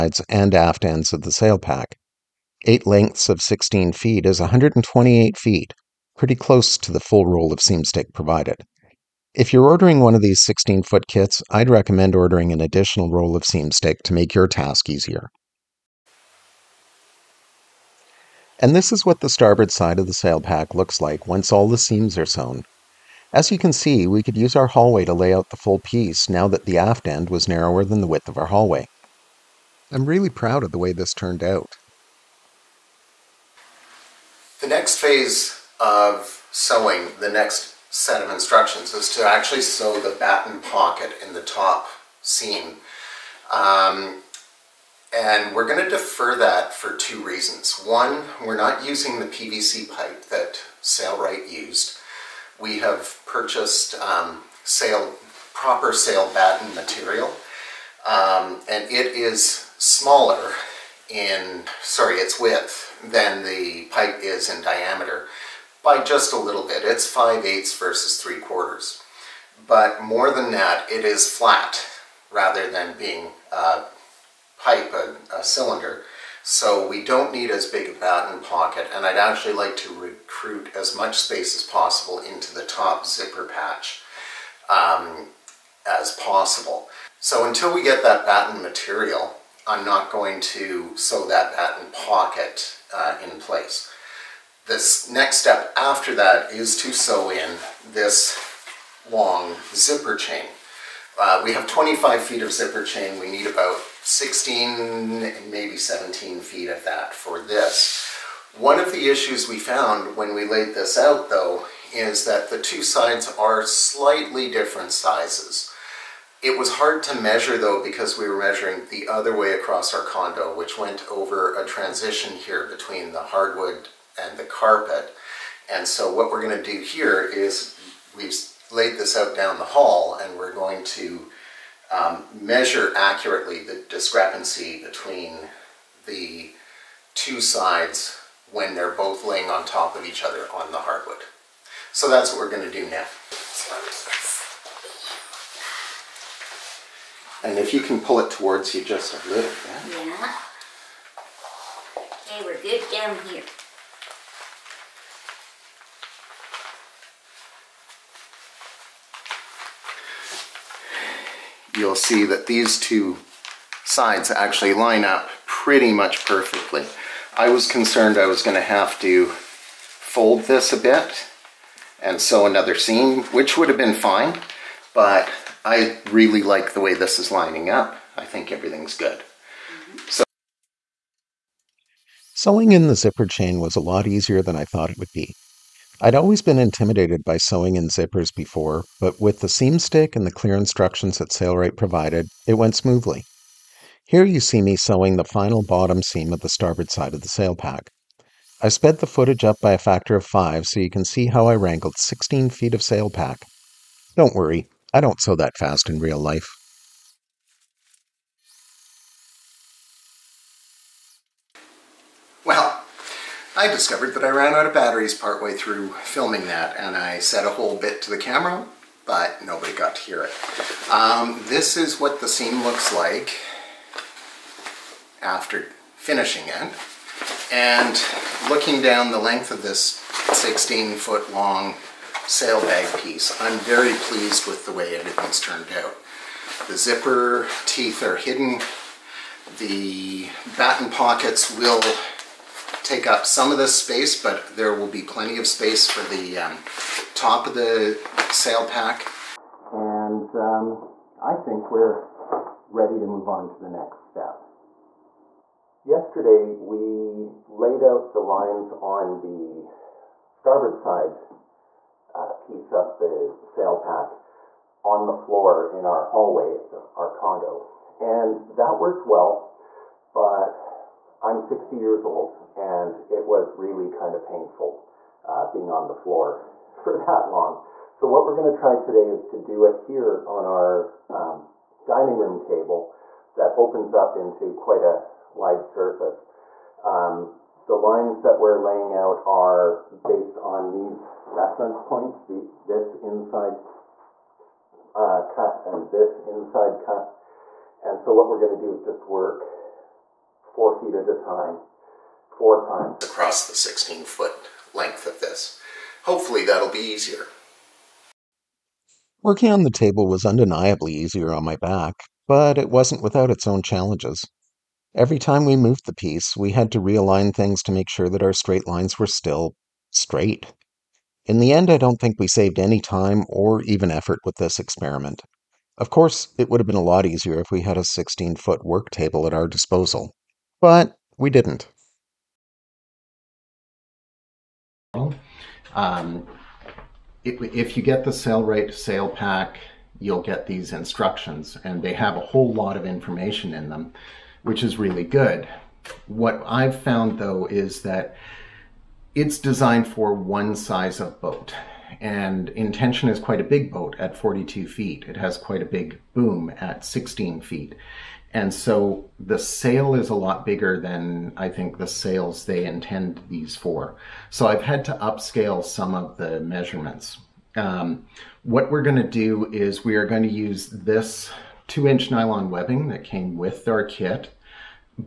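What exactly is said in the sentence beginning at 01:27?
So until we get that batten material, I'm not going to sew that batten pocket uh, in place.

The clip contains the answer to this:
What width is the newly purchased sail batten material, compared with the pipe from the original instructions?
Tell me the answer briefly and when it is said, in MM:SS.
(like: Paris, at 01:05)
5/8, at 01:07.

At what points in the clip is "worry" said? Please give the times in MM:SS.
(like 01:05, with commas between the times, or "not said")
03:24.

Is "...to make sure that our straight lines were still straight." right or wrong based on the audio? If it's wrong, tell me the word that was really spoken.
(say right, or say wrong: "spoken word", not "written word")
right.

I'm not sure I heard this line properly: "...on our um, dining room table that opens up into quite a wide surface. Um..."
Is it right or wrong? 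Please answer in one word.
right.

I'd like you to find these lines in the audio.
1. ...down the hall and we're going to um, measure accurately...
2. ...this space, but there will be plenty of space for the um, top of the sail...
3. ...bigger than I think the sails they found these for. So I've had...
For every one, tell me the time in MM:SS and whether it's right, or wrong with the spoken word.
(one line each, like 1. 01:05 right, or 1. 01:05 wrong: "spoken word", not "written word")
1. 02:09 right
2. 04:03 right
3. 06:00 wrong: "intend", not "found".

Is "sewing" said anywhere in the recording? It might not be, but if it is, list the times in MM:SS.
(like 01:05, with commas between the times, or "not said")
00:36, 03:02, 03:07, 03:14.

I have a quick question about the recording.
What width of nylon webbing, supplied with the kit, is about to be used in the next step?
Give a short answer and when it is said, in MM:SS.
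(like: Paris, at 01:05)
2 inch, at 06:11.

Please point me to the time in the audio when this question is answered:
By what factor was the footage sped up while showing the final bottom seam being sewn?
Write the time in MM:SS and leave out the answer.
03:20.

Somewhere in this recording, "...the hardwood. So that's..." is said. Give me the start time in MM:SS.
02:20.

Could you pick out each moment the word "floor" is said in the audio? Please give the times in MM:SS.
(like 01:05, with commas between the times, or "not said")
04:25, 04:35.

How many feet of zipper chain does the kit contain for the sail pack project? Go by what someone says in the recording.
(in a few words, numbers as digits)
25 feet.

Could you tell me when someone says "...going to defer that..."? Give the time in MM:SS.
00:45.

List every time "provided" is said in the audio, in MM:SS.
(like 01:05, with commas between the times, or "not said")
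00:08, 03:11.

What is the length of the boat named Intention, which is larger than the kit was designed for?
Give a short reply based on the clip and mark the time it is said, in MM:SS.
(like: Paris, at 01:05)
42 feet, at 05:54.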